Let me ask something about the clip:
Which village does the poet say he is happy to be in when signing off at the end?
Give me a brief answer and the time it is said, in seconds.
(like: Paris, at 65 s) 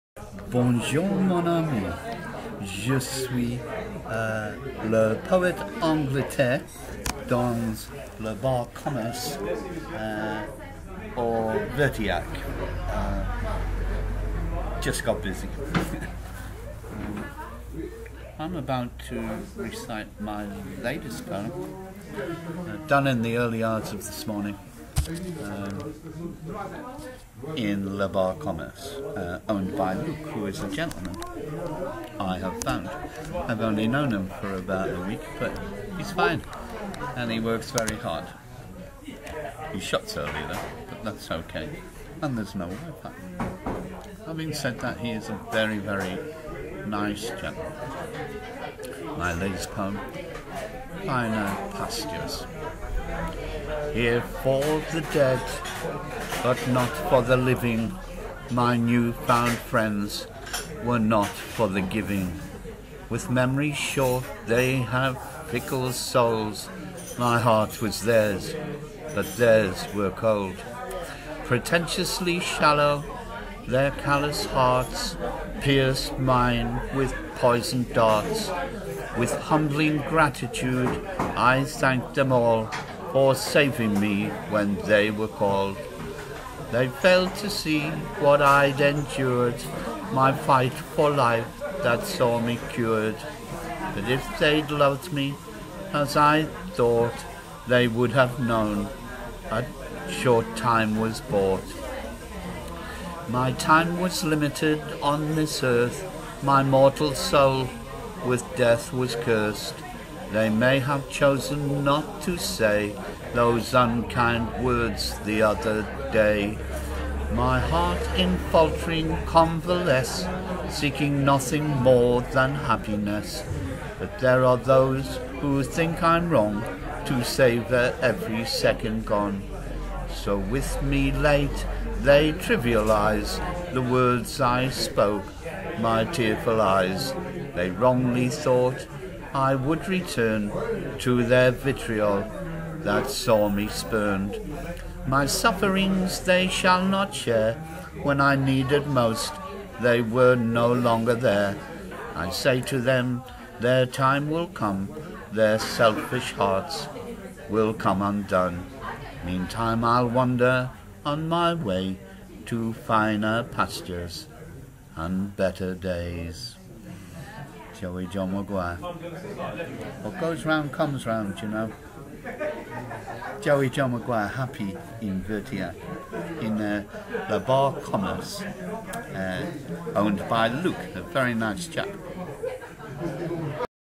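Vertia, at 175 s.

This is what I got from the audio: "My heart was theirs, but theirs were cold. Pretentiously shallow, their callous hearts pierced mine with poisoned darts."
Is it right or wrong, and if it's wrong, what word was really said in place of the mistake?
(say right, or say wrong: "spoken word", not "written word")
right.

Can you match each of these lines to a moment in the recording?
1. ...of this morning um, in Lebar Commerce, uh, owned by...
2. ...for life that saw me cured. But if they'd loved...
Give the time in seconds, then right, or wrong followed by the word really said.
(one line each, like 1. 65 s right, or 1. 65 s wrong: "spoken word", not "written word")
1. 23 s right
2. 90 s right.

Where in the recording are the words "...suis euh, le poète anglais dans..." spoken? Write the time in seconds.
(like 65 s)
2 s.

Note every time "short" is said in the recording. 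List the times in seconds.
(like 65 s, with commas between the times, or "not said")
63 s, 100 s.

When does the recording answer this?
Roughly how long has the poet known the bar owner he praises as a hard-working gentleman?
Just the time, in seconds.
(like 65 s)
34 s.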